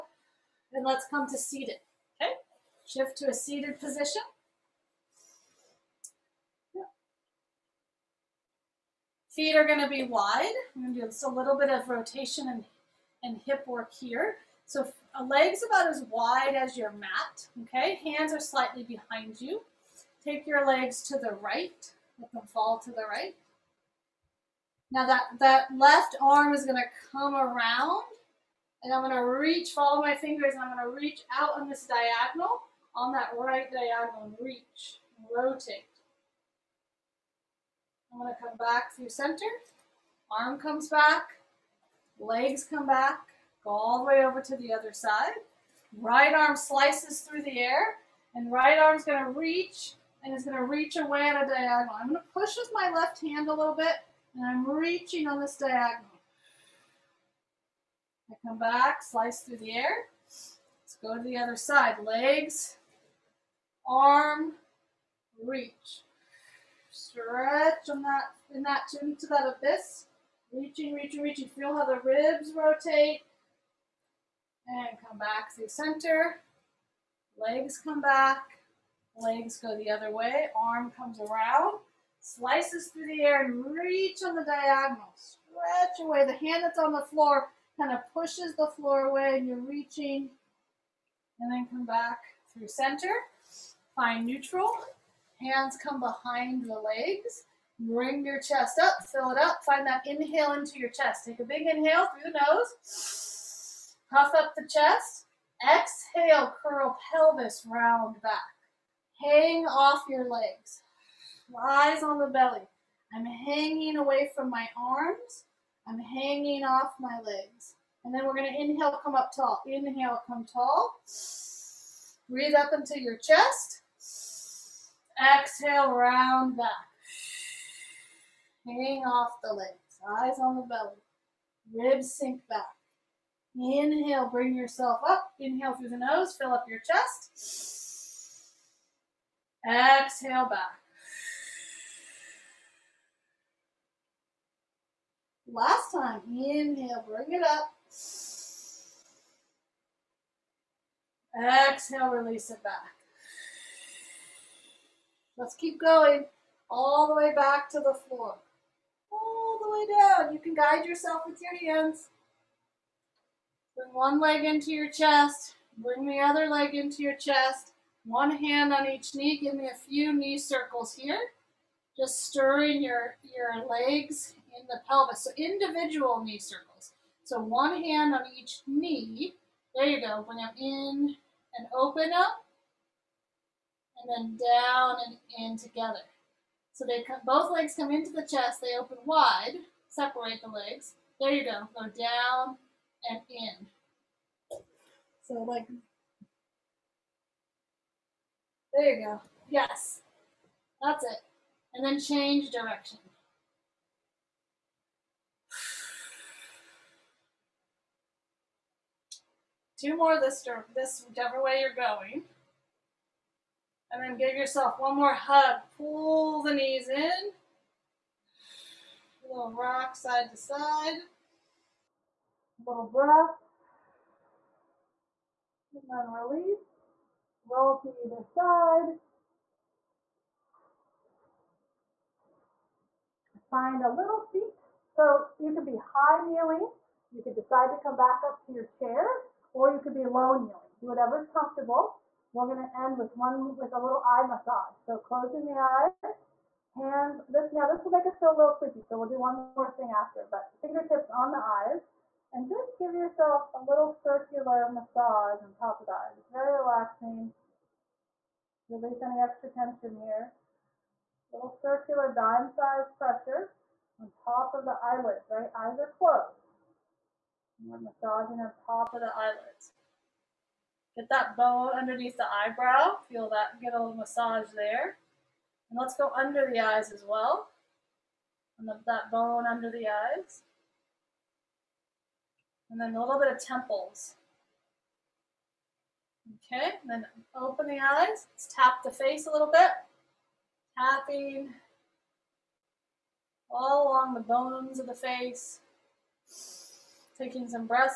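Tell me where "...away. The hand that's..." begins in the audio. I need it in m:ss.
1:26.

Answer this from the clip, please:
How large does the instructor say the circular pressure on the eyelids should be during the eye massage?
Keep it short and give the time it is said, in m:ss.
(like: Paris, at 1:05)
Dime-sized, at 4:22.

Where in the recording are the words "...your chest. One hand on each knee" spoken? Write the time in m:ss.
2:47.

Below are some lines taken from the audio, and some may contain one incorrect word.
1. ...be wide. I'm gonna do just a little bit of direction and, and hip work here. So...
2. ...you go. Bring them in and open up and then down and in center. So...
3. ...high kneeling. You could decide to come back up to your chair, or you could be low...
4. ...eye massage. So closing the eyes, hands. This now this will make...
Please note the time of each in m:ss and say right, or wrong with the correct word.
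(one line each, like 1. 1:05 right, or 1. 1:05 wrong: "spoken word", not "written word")
1. 0:09 wrong: "rotation", not "direction"
2. 2:59 wrong: "together", not "center"
3. 3:55 right
4. 4:04 right.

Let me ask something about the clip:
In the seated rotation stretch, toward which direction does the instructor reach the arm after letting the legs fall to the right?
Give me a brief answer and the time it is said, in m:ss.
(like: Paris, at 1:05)
Right diagonal, at 0:33.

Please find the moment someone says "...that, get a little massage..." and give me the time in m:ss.
4:33.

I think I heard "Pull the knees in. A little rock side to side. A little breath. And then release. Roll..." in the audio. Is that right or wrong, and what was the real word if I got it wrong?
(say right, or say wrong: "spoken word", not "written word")
right.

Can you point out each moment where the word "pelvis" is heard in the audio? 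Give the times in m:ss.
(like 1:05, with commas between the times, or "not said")
1:47, 2:54.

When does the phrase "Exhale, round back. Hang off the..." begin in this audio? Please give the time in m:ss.
2:05.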